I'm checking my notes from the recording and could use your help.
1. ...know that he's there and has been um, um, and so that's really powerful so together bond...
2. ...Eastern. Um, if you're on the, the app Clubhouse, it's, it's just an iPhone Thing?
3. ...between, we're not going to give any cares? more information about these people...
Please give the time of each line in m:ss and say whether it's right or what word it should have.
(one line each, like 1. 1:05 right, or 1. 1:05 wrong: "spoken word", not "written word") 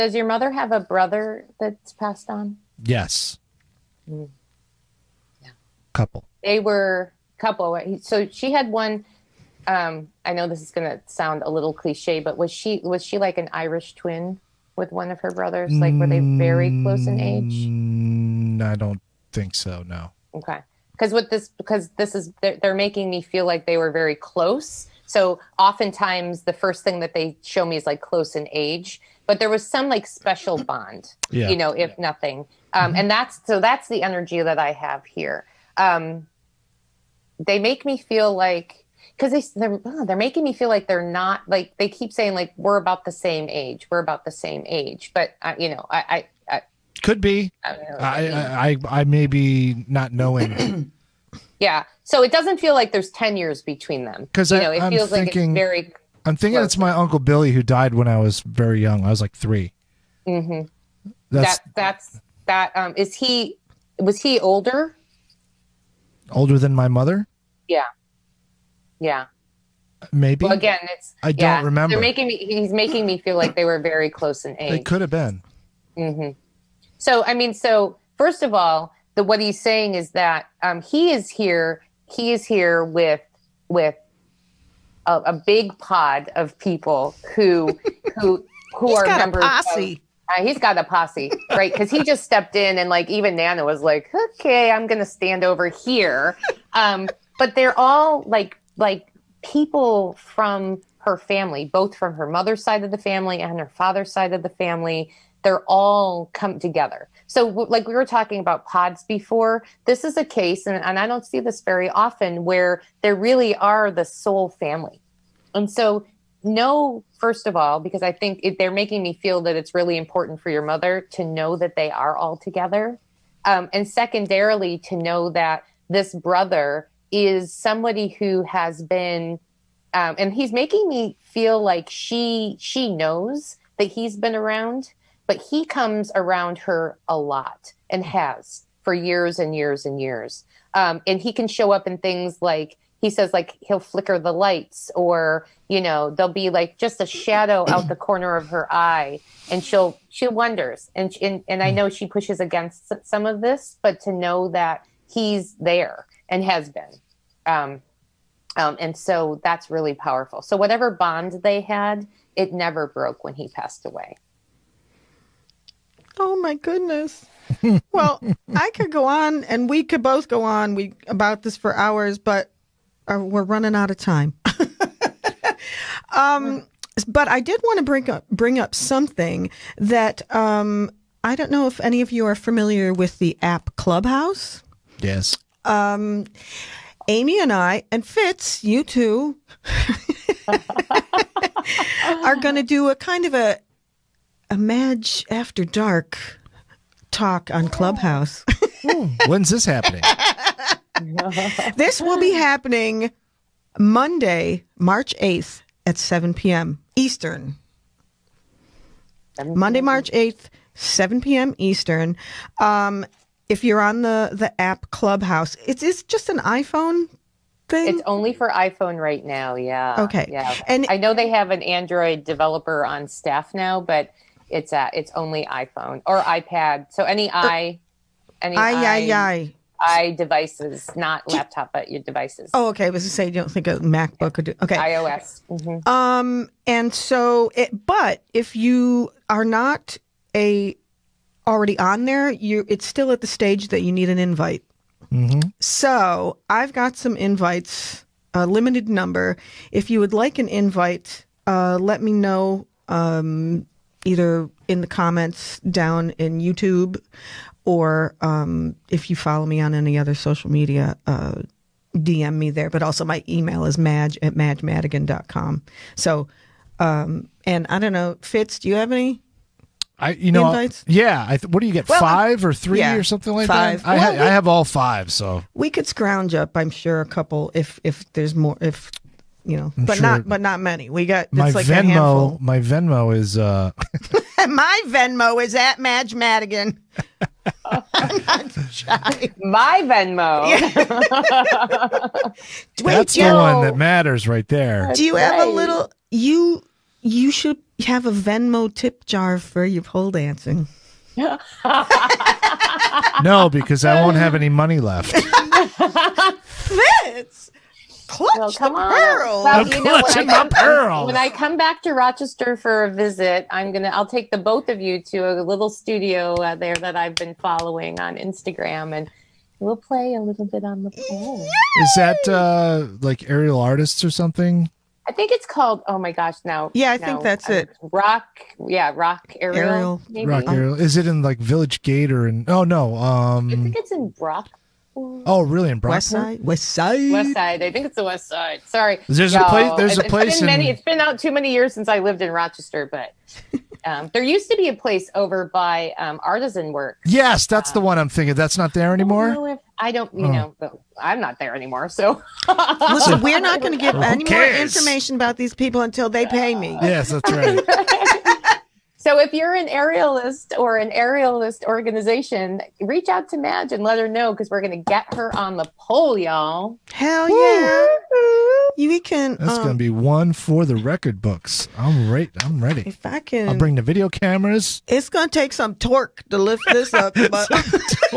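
1. 2:34 wrong: "whatever", not "together"
2. 3:31 right
3. 5:52 wrong: "listen", not "between".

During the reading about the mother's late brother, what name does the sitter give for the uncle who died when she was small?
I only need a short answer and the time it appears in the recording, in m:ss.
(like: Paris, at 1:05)
Uncle Billy, at 0:56.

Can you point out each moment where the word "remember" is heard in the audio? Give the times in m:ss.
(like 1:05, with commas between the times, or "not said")
1:11.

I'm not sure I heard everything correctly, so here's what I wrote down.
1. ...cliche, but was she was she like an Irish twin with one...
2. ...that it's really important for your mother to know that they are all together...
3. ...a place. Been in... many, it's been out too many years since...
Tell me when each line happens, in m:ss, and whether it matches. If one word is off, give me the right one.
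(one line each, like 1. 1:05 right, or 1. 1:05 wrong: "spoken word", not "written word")
1. 0:11 right
2. 1:59 right
3. 5:39 right.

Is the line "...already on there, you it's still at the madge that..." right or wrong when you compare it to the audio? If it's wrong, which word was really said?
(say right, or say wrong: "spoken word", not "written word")
wrong: "stage", not "madge".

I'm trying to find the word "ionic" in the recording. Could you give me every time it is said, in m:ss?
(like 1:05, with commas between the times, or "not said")
not said.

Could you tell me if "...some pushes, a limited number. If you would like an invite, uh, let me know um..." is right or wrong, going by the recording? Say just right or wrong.
wrong.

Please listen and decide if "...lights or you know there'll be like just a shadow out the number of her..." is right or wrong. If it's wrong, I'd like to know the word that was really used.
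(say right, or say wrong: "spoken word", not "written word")
wrong: "corner", not "number".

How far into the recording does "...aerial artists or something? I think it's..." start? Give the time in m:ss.
5:23.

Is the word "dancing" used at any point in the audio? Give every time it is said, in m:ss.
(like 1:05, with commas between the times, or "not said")
5:00.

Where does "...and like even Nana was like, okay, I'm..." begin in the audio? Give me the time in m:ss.
1:32.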